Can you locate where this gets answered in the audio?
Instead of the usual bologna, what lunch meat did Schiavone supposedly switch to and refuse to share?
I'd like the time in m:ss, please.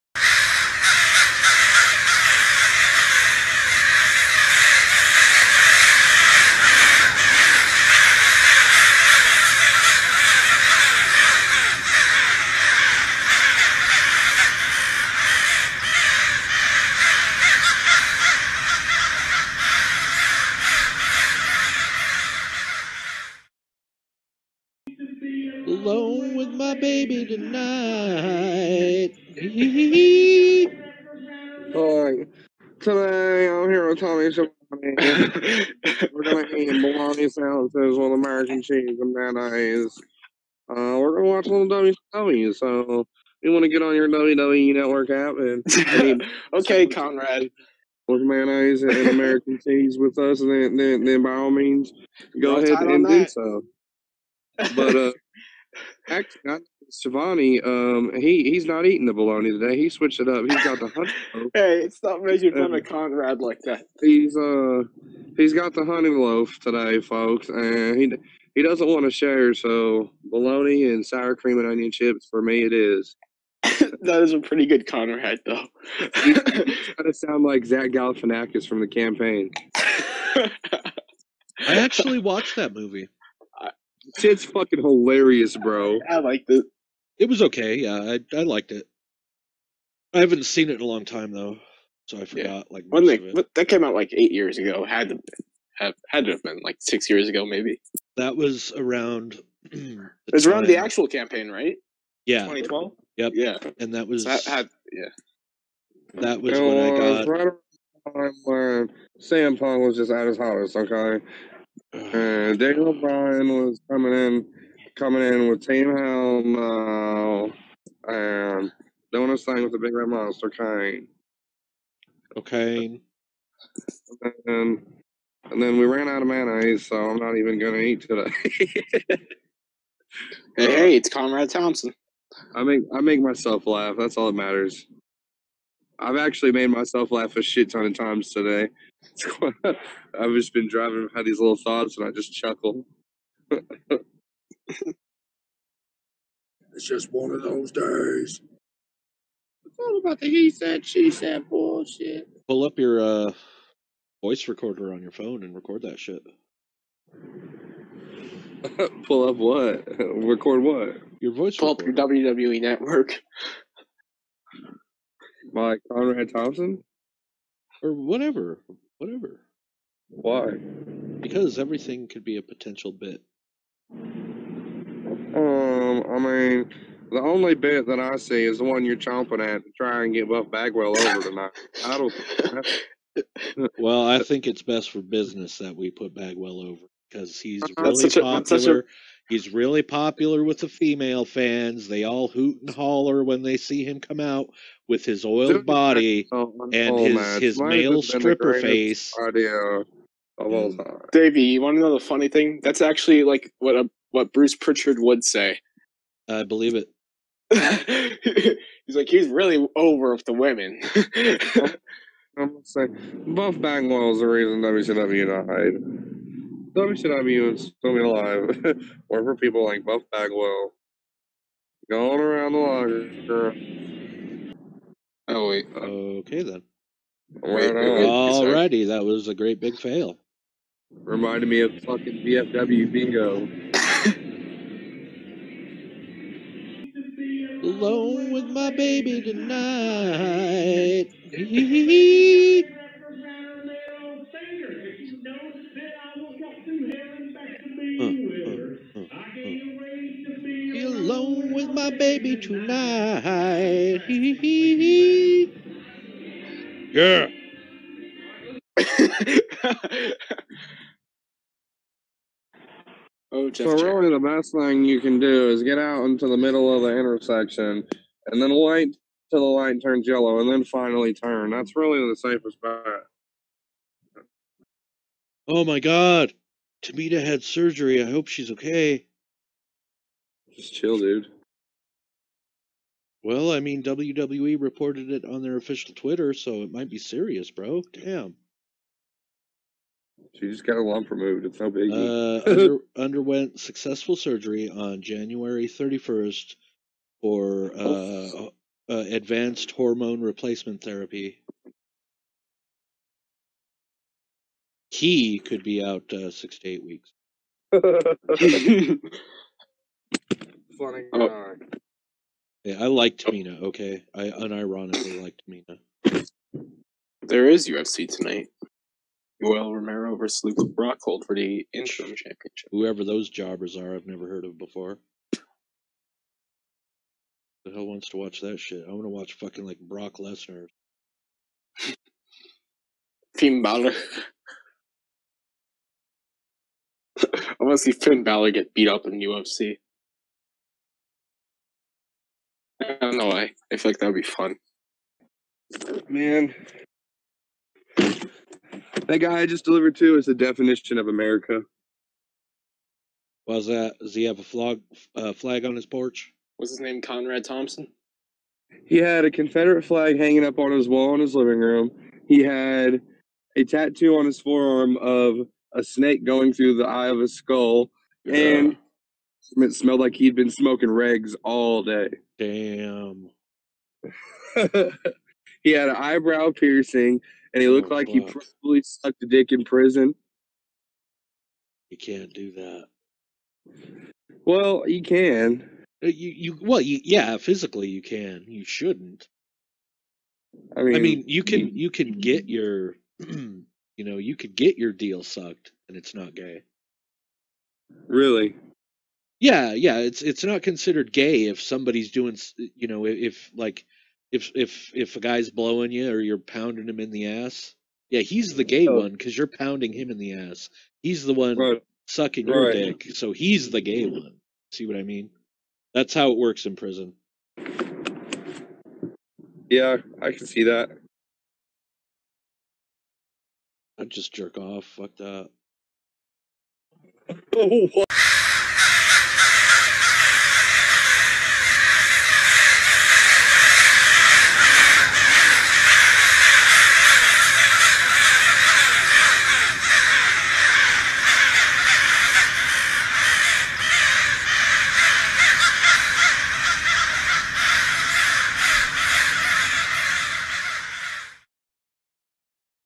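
1:05.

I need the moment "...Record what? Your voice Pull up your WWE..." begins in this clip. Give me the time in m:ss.
2:39.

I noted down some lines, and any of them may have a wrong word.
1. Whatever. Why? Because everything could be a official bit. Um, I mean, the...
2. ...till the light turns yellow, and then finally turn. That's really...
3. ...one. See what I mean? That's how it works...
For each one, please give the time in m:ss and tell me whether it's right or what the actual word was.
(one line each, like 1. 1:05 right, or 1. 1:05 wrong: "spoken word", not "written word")
1. 2:48 wrong: "potential", not "official"
2. 4:29 right
3. 6:54 right.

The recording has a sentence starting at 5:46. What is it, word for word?
Man, that guy I just delivered to is the definition of America.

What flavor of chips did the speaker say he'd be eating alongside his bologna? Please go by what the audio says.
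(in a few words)
sour cream and onion.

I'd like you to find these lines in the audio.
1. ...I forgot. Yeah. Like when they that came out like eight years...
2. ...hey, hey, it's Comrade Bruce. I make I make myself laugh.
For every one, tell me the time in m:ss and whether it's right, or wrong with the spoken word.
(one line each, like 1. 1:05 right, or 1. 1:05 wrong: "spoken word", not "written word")
1. 1:32 right
2. 2:10 wrong: "Thompson", not "Bruce".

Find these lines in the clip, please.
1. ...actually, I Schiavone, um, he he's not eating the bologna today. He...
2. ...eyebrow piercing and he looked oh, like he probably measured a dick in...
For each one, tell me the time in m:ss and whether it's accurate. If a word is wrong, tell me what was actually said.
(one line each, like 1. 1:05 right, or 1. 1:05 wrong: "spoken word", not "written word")
1. 0:56 right
2. 6:15 wrong: "sucked", not "measured".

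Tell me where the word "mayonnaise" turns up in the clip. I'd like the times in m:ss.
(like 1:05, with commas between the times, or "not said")
0:39, 0:48, 2:06.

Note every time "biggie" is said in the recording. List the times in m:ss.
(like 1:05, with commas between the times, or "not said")
4:51.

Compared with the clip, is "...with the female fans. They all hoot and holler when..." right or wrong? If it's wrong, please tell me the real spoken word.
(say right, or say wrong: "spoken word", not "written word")
right.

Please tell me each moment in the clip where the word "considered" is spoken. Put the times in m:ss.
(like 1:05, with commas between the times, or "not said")
6:40.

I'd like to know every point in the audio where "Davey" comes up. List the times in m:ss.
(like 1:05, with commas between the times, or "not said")
3:21.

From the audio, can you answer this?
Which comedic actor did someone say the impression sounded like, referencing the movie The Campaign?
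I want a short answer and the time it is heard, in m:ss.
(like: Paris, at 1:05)
Zach Galifianakis, at 1:17.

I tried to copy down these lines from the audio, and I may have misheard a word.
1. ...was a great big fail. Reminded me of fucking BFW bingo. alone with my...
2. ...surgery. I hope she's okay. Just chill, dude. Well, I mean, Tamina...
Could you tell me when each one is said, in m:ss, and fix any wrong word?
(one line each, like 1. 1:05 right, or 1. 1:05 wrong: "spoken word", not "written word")
1. 3:49 right
2. 4:37 wrong: "WWE", not "Tamina".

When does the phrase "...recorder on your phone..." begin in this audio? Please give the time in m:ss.
2:34.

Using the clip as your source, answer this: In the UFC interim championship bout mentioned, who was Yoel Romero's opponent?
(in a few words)
Luke Rockhold.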